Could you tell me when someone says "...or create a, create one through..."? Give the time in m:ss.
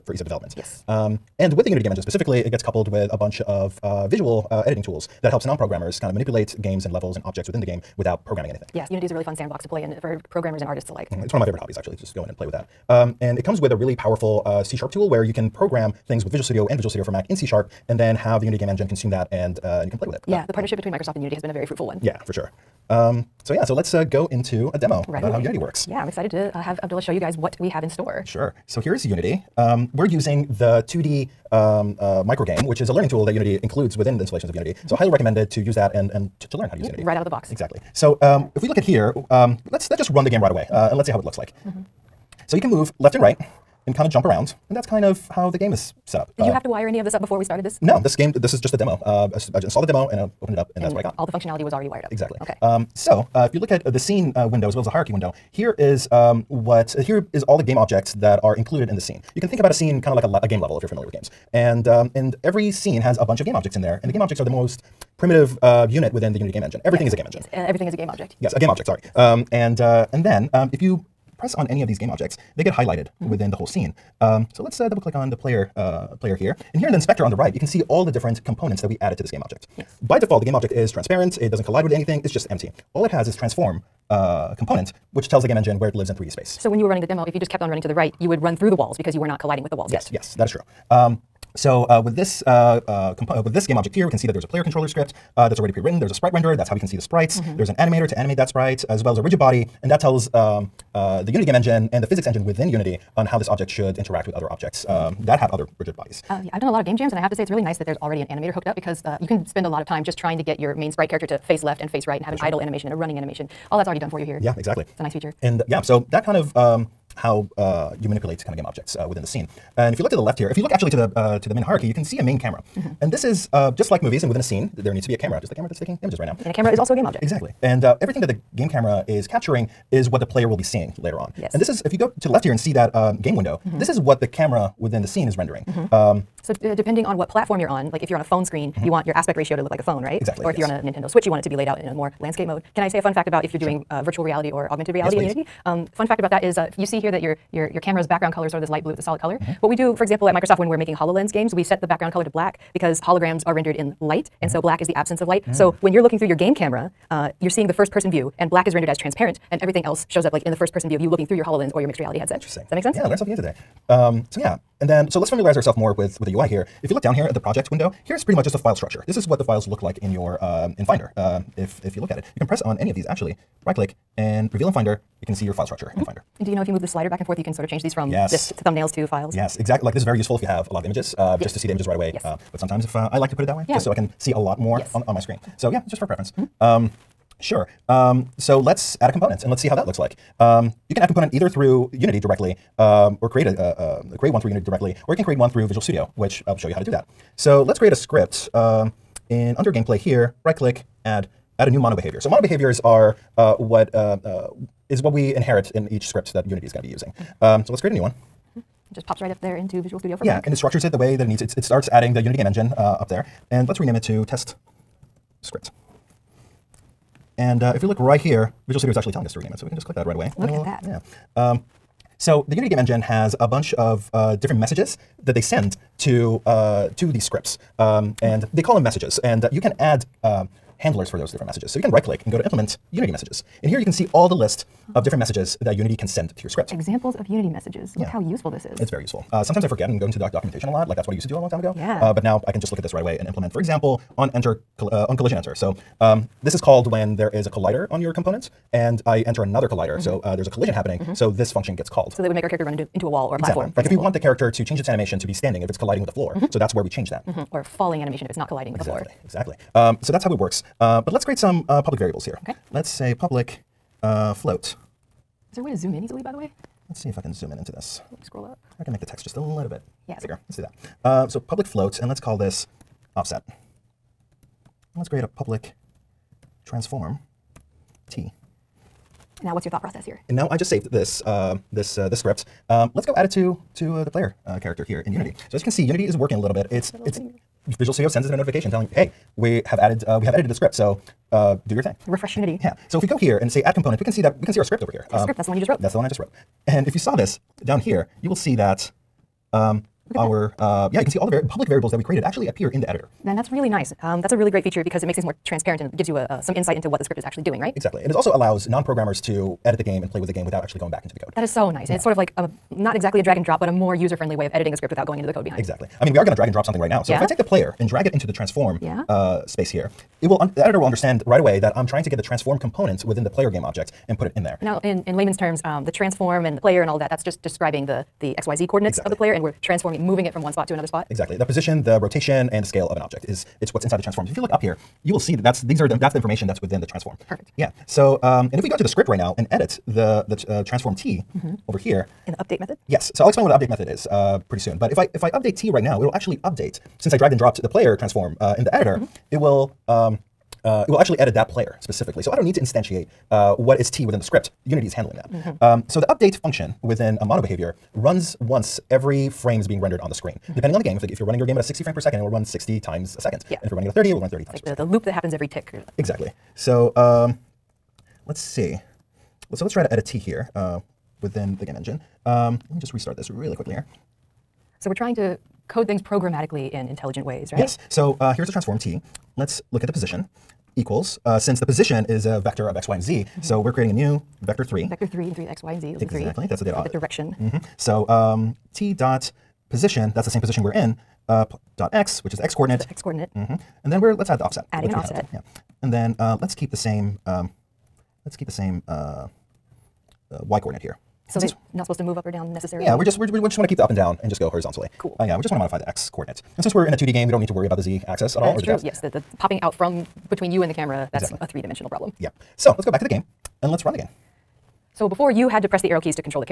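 3:13.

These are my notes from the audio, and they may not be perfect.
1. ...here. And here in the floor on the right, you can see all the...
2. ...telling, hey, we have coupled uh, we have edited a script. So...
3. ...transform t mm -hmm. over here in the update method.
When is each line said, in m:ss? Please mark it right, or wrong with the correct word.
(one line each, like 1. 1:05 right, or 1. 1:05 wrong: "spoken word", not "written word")
1. 1:16 wrong: "inspector", not "floor"
2. 4:48 wrong: "added", not "coupled"
3. 5:40 right.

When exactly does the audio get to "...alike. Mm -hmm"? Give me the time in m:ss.
0:10.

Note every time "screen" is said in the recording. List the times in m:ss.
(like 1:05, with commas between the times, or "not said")
2:18, 3:05, 6:00.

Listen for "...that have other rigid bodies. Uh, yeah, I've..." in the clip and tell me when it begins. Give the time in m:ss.
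1:45.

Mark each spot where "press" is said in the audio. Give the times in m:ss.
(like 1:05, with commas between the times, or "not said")
1:11, 2:52, 6:55.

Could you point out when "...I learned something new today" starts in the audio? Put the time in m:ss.
2:43.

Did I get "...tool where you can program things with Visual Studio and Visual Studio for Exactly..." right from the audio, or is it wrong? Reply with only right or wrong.
wrong.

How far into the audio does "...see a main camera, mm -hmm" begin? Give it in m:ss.
2:02.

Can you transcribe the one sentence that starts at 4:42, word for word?
Um, let's go add it to to uh, the player uh, character here in Unity.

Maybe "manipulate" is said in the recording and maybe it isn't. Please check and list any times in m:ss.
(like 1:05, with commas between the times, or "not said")
0:06, 1:58.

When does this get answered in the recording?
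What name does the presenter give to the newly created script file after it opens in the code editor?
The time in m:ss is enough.
3:34.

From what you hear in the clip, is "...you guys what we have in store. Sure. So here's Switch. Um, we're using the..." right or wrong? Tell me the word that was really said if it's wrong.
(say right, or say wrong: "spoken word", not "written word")
wrong: "Unity", not "Switch".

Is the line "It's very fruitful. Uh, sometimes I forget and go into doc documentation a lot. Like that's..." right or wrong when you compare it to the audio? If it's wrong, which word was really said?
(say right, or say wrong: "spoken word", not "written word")
wrong: "useful", not "fruitful".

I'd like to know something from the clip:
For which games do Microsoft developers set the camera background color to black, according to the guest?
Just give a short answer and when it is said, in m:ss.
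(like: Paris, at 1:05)
HoloLens games, at 2:30.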